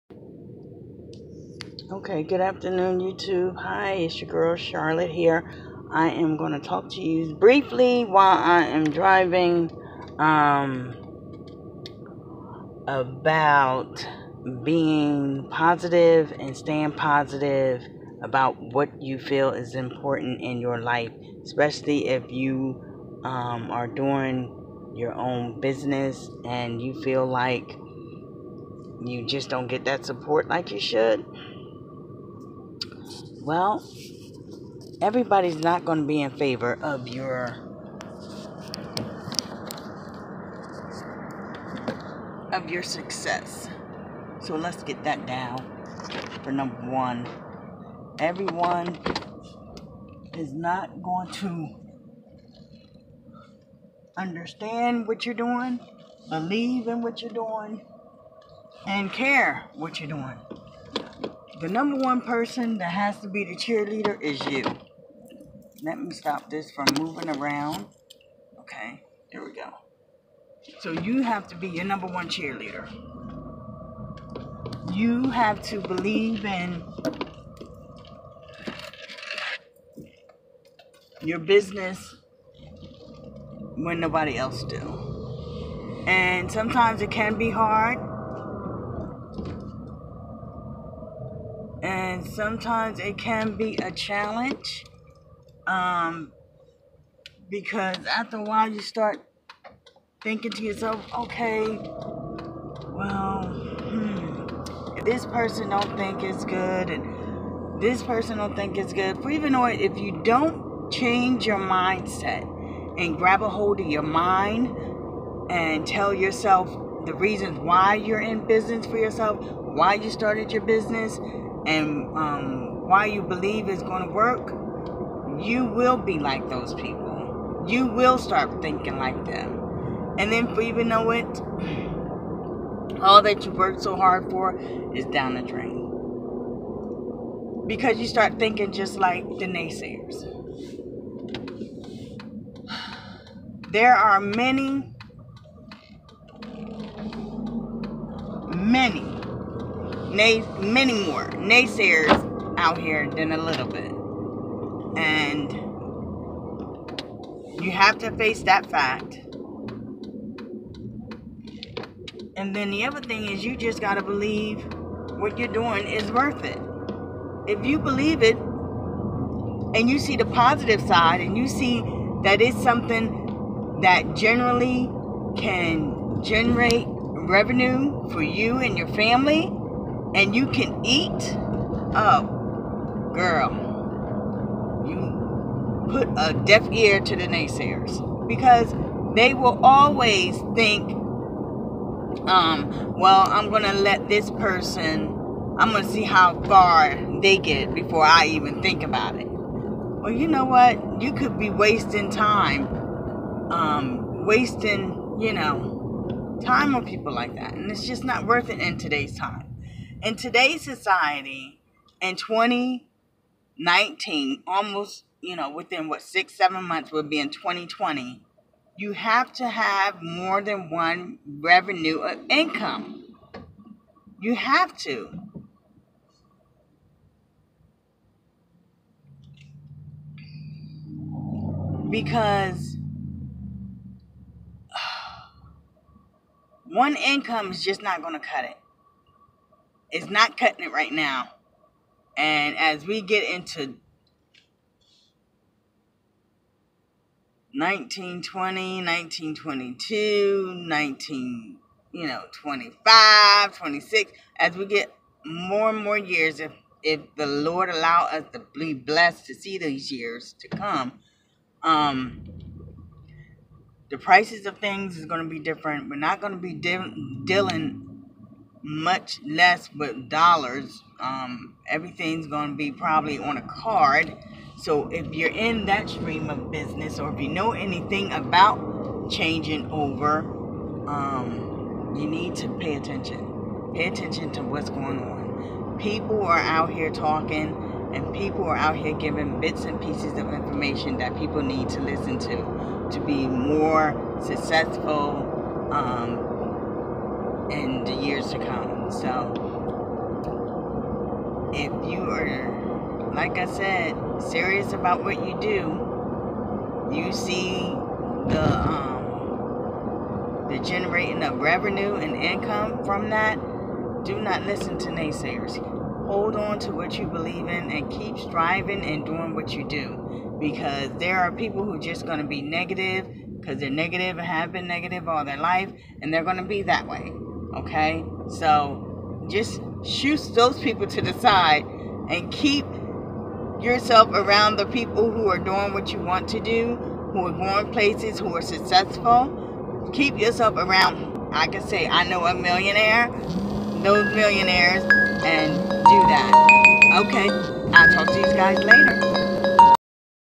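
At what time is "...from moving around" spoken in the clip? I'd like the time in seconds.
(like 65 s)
66 s.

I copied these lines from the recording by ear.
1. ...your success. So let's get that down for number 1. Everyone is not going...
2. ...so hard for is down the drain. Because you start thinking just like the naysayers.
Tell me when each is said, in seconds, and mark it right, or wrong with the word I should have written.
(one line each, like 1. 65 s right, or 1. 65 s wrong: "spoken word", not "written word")
1. 42 s right
2. 133 s right.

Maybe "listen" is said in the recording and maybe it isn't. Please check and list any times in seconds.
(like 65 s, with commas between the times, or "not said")
291 s, 314 s.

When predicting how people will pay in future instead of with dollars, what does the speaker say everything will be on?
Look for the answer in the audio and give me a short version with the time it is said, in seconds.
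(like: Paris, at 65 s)
a card, at 273 s.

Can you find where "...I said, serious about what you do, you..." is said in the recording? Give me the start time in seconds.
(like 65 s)
303 s.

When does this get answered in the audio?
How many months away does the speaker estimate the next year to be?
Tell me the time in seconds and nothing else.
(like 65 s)
216 s.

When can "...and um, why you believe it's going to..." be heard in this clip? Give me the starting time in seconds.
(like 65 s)
121 s.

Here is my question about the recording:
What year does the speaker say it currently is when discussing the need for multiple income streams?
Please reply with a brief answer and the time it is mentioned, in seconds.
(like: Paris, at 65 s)
2019, at 212 s.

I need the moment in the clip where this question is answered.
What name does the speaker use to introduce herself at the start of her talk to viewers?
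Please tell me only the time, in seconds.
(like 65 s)
4 s.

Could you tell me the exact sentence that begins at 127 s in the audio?
You will start thinking like them.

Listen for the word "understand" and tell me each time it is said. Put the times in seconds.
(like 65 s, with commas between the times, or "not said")
54 s.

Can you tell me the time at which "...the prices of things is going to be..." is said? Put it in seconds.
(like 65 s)
263 s.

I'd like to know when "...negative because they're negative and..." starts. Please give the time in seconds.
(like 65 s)
322 s.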